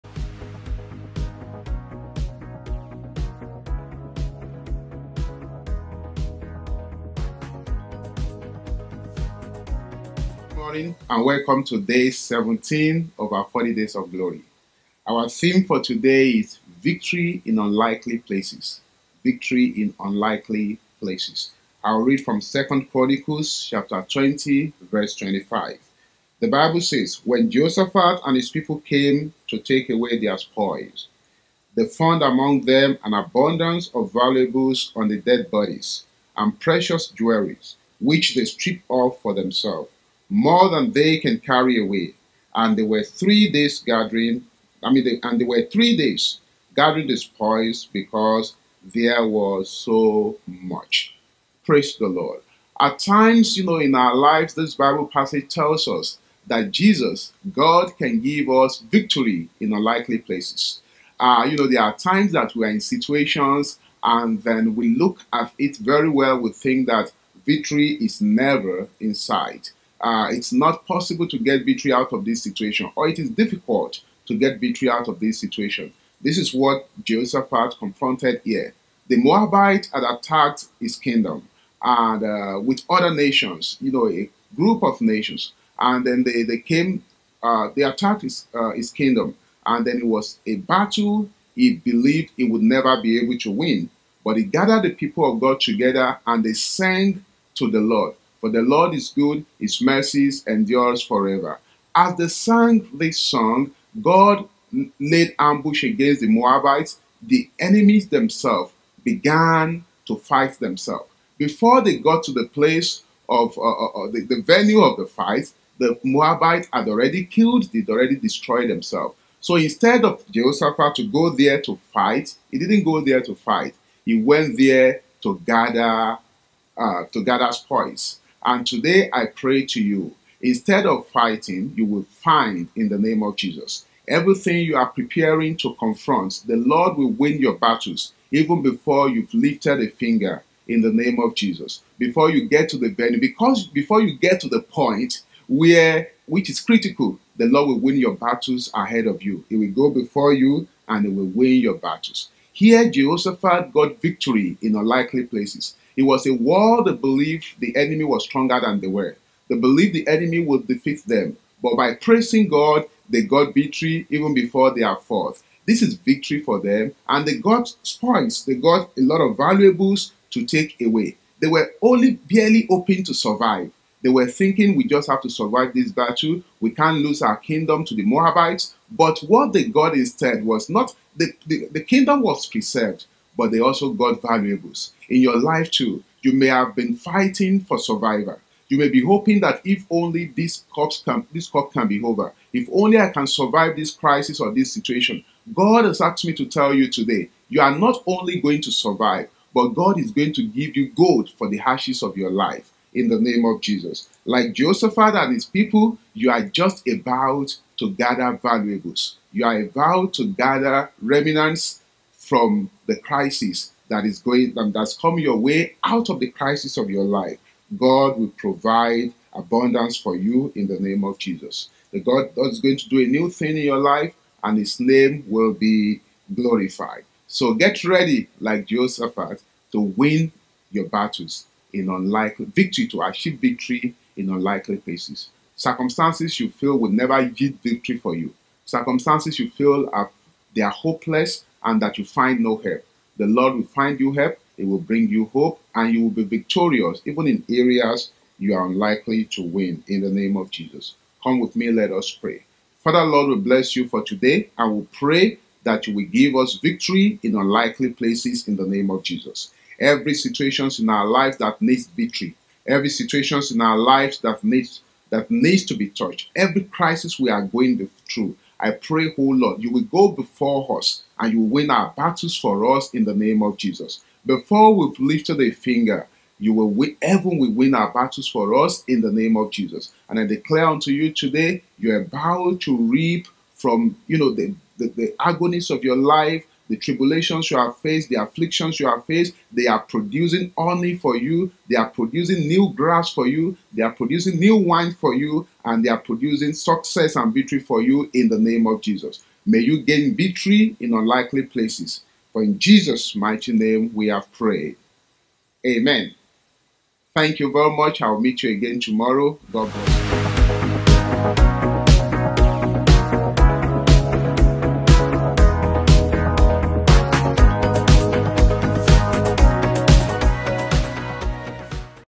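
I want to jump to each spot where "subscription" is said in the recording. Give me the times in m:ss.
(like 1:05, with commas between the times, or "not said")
not said.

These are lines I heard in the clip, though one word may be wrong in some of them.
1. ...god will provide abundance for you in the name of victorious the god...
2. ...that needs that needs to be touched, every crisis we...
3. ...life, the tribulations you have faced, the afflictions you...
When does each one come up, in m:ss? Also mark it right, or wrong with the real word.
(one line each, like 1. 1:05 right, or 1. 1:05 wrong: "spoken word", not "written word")
1. 3:37 wrong: "jesus", not "victorious"
2. 4:24 right
3. 4:45 right.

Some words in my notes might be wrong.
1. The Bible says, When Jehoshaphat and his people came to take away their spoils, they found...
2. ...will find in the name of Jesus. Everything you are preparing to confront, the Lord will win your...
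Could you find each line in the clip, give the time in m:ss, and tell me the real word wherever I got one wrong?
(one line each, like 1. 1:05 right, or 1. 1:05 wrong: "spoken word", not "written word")
1. 0:26 right
2. 2:11 right.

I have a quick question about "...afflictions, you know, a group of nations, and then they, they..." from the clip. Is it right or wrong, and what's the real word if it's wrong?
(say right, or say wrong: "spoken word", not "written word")
wrong: "nations", not "afflictions".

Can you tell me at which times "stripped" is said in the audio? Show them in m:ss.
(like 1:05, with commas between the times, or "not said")
0:38.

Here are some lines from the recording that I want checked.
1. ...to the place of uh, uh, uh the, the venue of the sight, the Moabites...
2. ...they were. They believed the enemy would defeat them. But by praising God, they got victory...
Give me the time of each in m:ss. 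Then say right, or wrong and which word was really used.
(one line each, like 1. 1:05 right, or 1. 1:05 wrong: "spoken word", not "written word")
1. 1:52 wrong: "fight", not "sight"
2. 2:38 right.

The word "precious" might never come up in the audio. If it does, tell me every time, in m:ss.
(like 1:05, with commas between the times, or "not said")
0:36.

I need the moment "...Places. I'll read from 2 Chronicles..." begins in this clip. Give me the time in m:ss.
0:20.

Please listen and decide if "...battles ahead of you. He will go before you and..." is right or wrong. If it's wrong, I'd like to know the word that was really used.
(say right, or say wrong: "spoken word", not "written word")
right.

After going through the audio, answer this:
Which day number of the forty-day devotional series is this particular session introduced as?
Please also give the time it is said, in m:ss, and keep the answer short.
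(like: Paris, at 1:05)
17, at 0:11.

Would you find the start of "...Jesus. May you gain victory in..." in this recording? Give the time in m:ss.
4:58.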